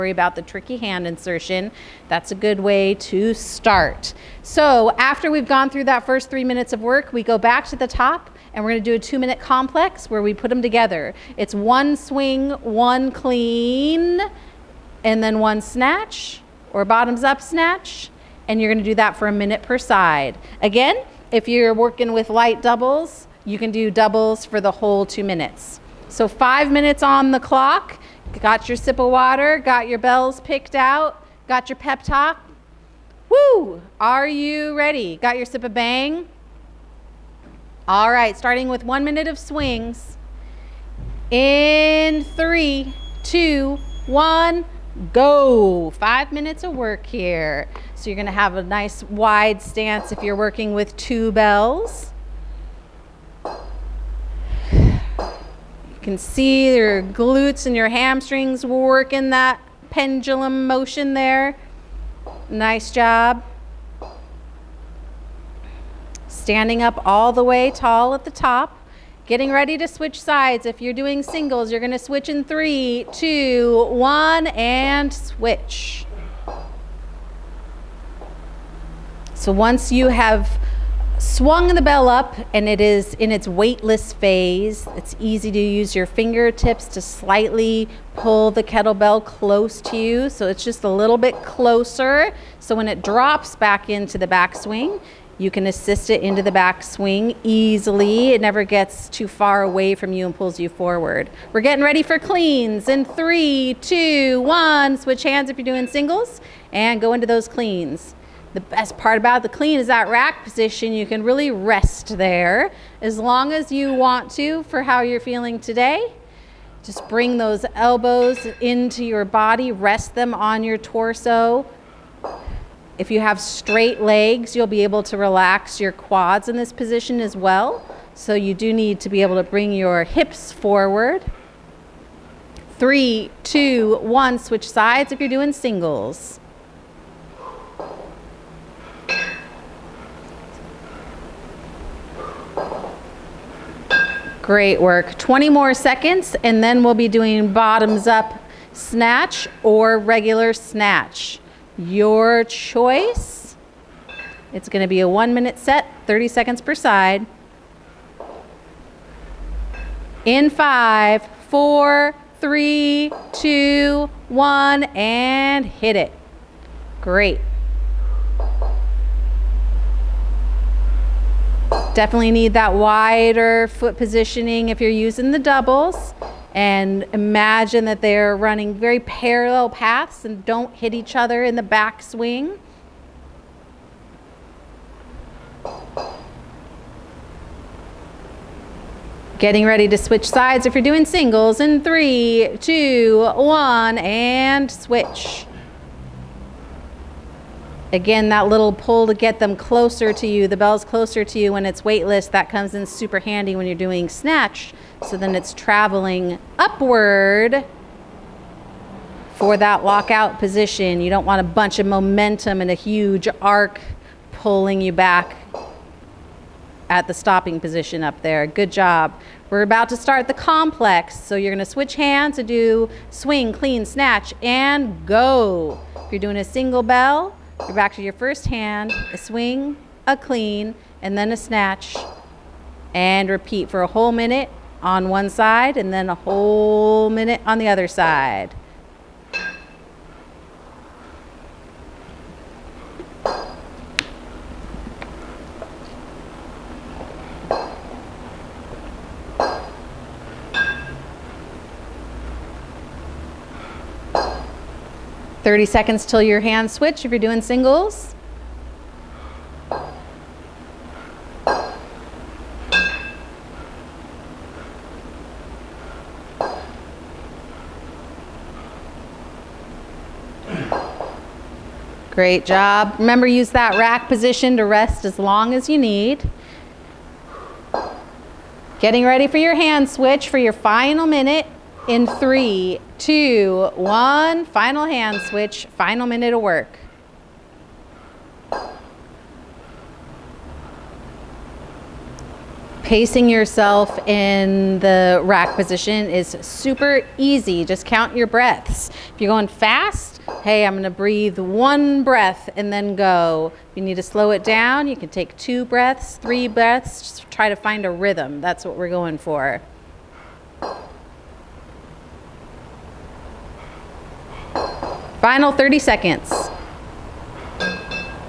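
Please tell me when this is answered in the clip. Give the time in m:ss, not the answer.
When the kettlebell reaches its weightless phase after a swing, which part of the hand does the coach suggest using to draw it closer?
1:26.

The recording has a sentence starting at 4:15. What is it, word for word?
30 seconds till your hands switch if you're doing singles.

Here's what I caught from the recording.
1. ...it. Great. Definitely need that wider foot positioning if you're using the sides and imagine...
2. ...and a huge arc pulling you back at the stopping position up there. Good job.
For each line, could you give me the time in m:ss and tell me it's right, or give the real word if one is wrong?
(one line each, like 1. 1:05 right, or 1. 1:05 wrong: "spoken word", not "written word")
1. 2:45 wrong: "doubles", not "sides"
2. 3:32 right.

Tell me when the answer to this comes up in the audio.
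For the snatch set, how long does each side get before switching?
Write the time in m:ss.
2:36.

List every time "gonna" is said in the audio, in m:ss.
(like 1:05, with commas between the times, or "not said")
0:08, 0:18, 0:48, 1:11, 5:00.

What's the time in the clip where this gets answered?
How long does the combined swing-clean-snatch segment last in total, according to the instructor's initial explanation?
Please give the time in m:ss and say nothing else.
0:08.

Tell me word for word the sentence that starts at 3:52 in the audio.
And repeat for a whole minute on one side and then a whole minute on the other side.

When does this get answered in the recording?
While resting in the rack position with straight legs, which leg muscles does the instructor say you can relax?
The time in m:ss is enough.
2:05.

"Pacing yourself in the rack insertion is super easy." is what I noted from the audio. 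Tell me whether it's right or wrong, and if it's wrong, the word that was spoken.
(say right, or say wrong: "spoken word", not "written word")
wrong: "position", not "insertion".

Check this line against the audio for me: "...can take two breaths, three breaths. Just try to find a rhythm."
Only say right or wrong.
right.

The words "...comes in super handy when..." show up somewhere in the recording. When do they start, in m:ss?
3:22.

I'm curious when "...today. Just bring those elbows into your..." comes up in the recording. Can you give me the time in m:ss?
1:55.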